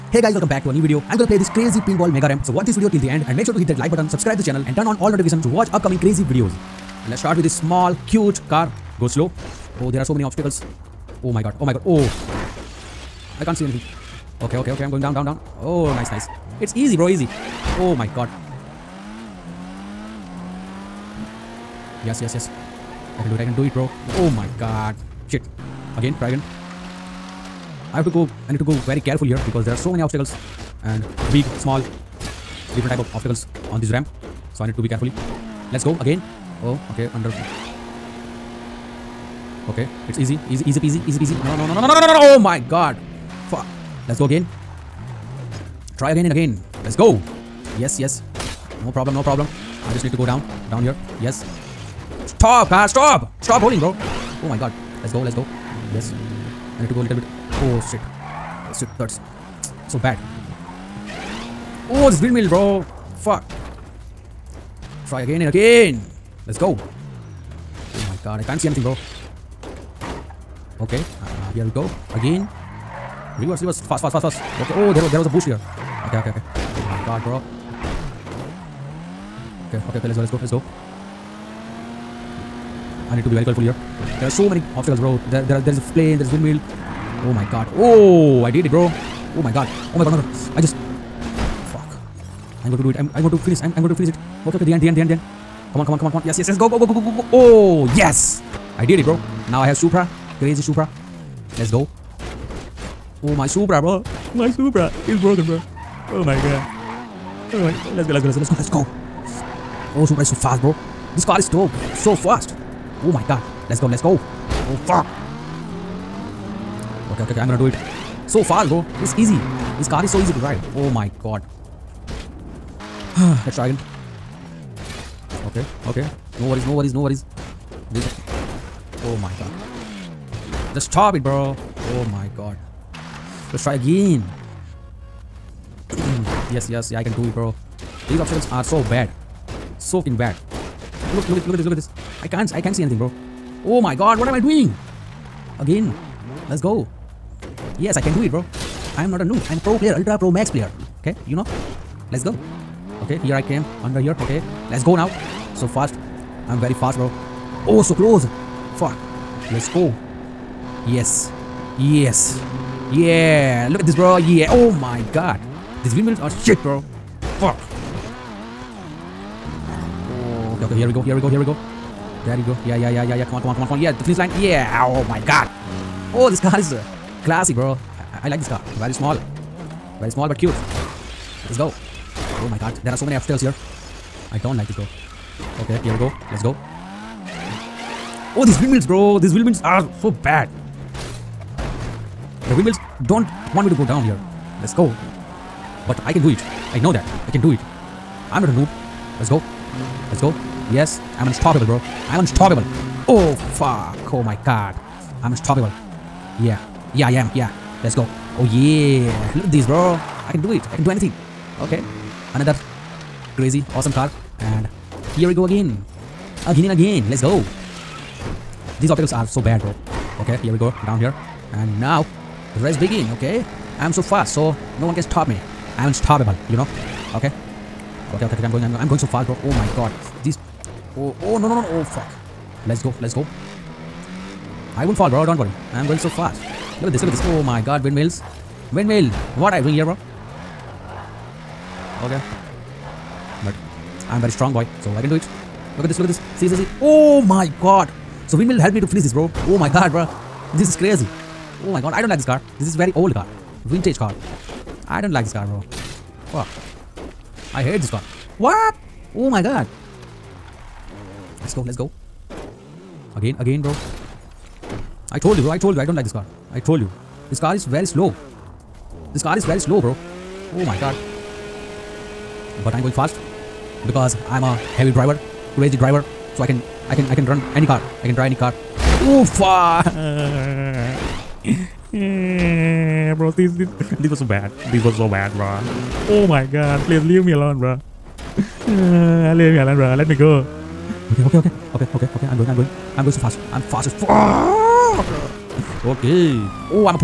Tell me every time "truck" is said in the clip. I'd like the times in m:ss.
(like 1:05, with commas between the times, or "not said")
not said.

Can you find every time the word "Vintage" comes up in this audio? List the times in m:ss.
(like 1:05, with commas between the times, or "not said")
4:13.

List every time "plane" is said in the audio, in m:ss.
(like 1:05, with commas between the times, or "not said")
1:25.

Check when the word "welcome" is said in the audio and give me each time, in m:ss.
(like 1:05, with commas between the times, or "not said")
0:00.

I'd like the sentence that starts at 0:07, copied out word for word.
Let's start with this small cute car.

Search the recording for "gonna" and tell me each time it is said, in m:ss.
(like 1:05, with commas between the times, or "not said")
0:01, 1:57.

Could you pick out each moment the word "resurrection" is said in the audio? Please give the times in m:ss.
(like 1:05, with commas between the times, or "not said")
not said.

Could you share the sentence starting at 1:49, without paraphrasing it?
Oh, Supra is so fast, bro.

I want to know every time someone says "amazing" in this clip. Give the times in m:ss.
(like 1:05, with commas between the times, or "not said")
not said.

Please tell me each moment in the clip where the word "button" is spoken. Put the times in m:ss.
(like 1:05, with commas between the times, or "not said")
0:03.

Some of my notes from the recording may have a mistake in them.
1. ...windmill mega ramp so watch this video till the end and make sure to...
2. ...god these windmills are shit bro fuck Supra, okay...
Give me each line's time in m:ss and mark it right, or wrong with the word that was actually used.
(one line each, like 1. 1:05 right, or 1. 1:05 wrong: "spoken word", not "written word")
1. 0:01 wrong: "pinball", not "windmill"
2. 2:45 wrong: "Okay", not "Supra".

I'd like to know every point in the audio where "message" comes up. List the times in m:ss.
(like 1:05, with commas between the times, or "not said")
not said.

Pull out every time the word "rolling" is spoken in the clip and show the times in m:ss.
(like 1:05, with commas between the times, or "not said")
0:53.